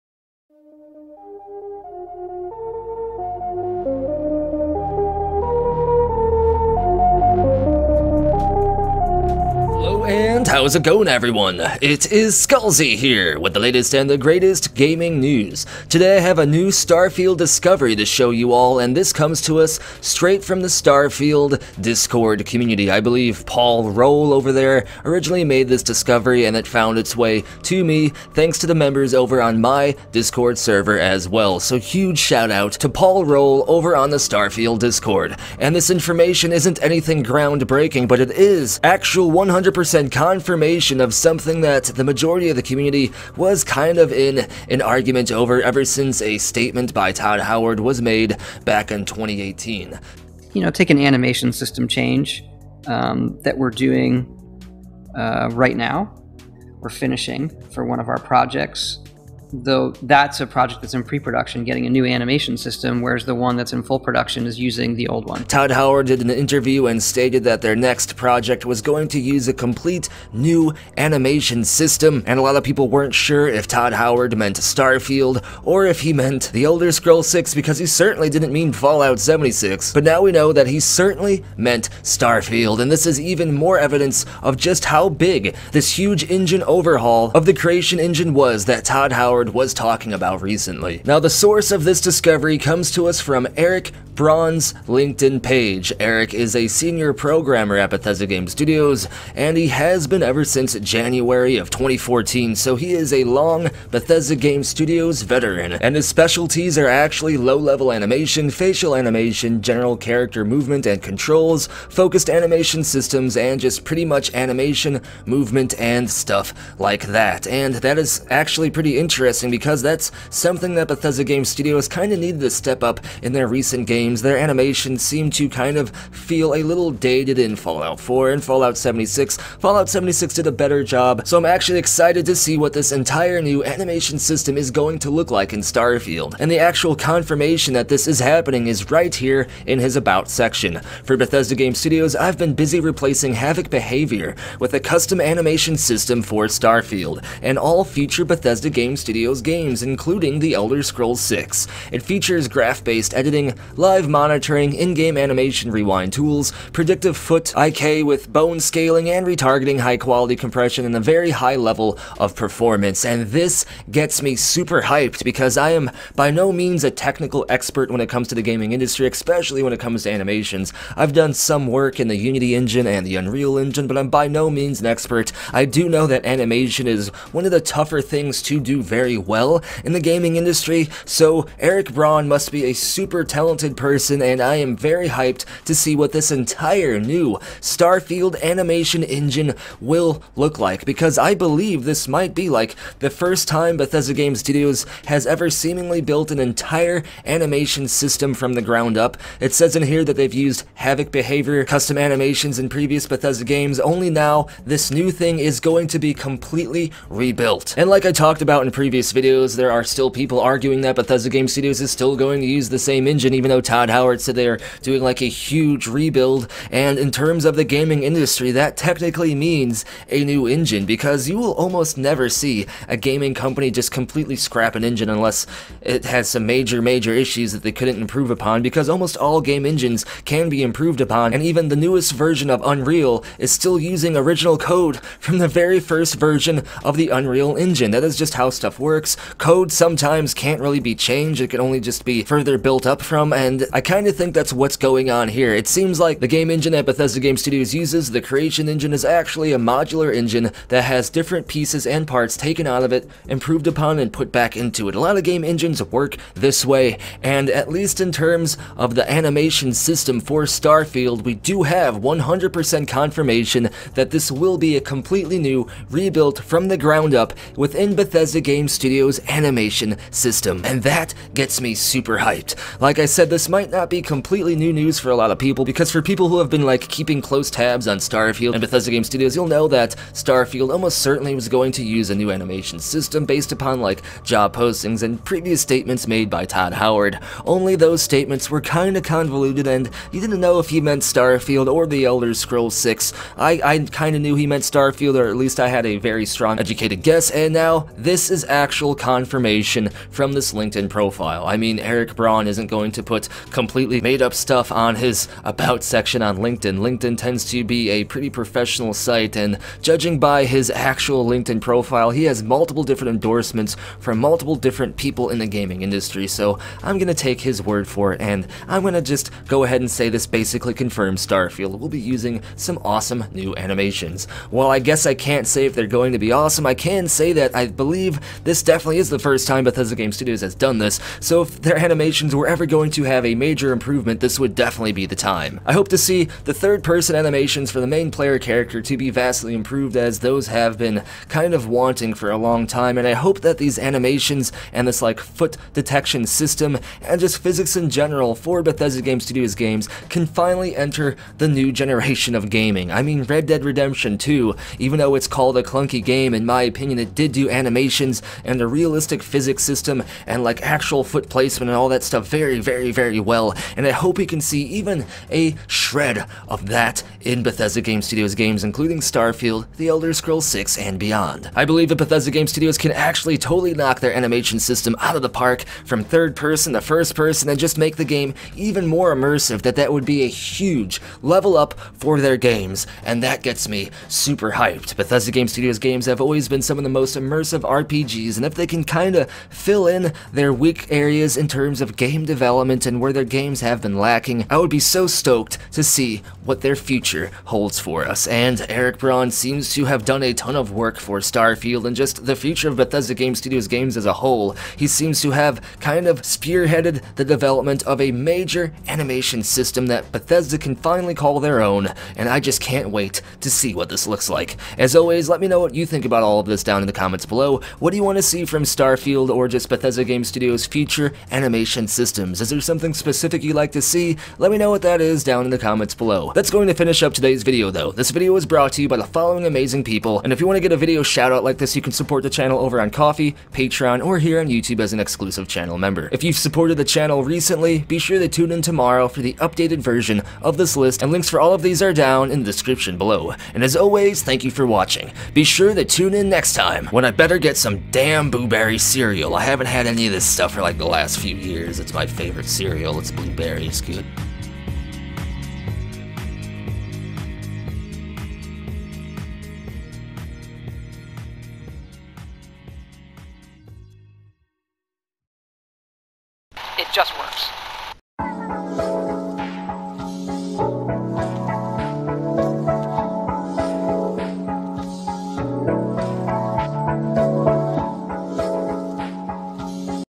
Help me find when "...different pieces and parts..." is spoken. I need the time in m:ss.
4:11.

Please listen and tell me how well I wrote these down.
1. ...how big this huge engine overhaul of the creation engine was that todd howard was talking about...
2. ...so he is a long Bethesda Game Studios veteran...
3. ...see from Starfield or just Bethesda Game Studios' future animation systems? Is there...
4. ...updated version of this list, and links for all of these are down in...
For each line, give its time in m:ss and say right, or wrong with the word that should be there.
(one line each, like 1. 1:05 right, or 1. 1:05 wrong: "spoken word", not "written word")
1. 1:24 right
2. 1:42 right
3. 6:58 right
4. 7:19 right.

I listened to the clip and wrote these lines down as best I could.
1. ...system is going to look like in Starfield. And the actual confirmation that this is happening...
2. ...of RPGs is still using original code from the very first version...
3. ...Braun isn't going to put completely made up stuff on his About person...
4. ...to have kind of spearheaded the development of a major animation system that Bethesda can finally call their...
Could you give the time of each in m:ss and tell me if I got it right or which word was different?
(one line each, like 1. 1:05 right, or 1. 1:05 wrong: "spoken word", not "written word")
1. 2:14 right
2. 3:52 wrong: "Unreal", not "RPGs"
3. 5:02 wrong: "section", not "person"
4. 6:45 right.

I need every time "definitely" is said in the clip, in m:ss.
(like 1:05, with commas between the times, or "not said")
5:28, 5:34.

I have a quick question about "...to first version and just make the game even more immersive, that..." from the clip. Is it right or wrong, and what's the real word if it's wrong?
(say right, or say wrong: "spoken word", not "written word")
wrong: "person", not "version".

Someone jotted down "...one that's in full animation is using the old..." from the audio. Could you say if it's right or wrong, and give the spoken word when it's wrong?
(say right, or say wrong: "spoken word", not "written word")
wrong: "production", not "animation".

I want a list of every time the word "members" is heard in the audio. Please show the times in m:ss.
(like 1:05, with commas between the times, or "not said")
0:28, 7:15.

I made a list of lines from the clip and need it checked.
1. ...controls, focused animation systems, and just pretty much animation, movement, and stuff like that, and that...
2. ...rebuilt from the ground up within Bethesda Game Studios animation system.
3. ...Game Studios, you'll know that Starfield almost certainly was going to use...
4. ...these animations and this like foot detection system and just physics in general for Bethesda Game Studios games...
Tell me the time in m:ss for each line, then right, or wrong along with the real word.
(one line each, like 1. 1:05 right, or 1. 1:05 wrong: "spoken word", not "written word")
1. 1:51 right
2. 4:25 right
3. 4:38 right
4. 5:43 right.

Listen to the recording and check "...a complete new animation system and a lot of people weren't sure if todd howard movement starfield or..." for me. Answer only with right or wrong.
wrong.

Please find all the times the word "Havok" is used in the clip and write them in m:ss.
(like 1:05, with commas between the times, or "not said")
2:23, 3:20.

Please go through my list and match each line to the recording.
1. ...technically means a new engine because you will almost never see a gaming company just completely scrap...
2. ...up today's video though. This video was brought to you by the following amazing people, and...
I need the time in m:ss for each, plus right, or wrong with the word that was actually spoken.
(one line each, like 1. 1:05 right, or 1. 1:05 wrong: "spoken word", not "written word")
1. 3:38 right
2. 7:07 right.